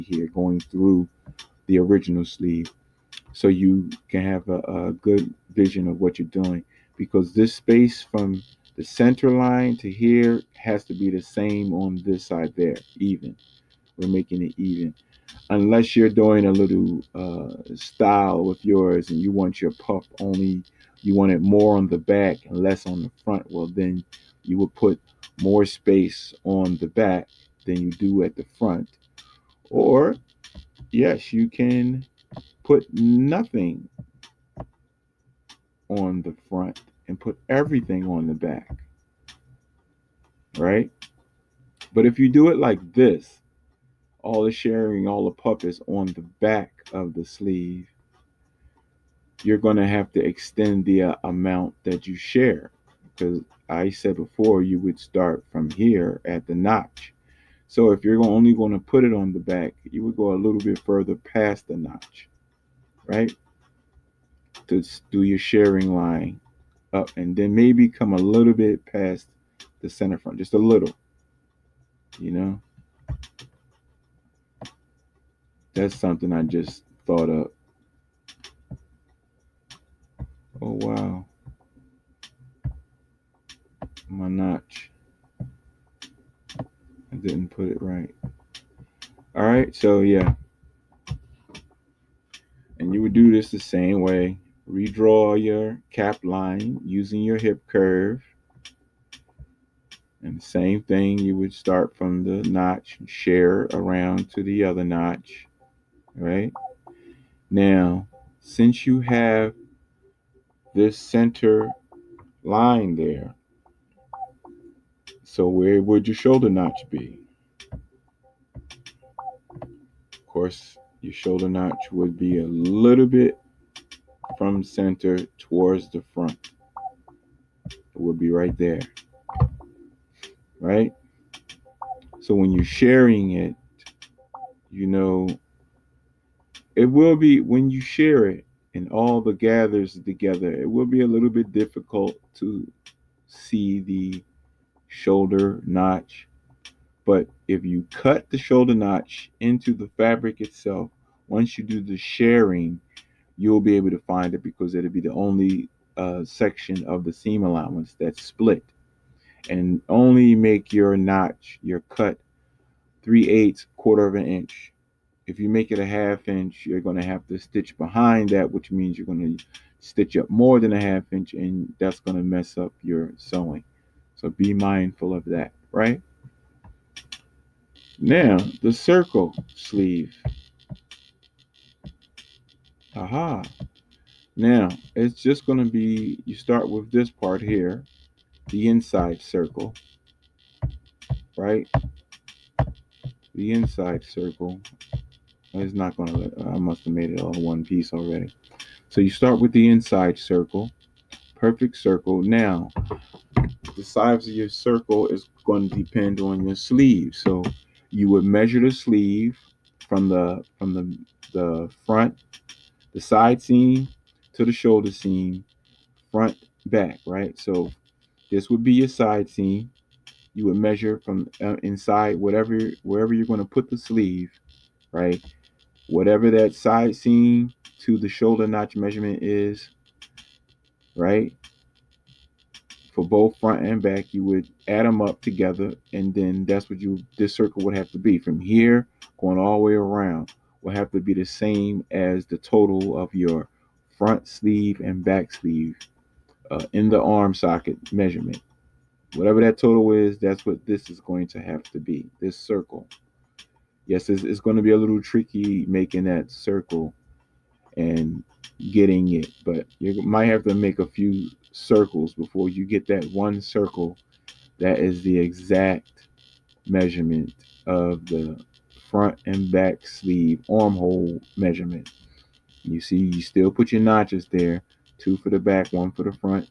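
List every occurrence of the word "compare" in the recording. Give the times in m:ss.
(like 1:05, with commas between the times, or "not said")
not said.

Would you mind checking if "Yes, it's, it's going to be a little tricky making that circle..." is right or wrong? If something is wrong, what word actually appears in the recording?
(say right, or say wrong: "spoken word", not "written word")
right.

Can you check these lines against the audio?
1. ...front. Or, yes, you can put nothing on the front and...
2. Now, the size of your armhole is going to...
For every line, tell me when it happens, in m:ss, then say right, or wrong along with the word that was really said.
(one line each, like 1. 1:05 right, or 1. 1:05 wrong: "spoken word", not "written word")
1. 0:28 right
2. 3:22 wrong: "circle", not "armhole".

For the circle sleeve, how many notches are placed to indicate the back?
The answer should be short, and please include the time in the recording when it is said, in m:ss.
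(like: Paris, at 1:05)
2, at 4:34.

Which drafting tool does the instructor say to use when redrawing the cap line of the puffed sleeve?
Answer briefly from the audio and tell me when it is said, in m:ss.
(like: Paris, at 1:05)
hip curve, at 1:37.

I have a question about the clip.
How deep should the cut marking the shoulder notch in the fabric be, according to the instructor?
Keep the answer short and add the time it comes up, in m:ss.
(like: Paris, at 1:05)
3/8 or 1/4 inch, at 2:43.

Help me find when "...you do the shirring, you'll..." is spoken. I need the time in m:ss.
2:31.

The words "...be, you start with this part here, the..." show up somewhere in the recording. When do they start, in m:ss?
3:05.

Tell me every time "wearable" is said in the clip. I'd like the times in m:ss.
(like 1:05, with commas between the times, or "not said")
not said.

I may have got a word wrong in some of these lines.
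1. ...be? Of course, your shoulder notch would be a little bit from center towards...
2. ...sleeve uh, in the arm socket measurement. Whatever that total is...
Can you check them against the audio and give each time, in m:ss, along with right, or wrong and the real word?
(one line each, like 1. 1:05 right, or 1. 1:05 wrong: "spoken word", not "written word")
1. 1:56 right
2. 4:05 right.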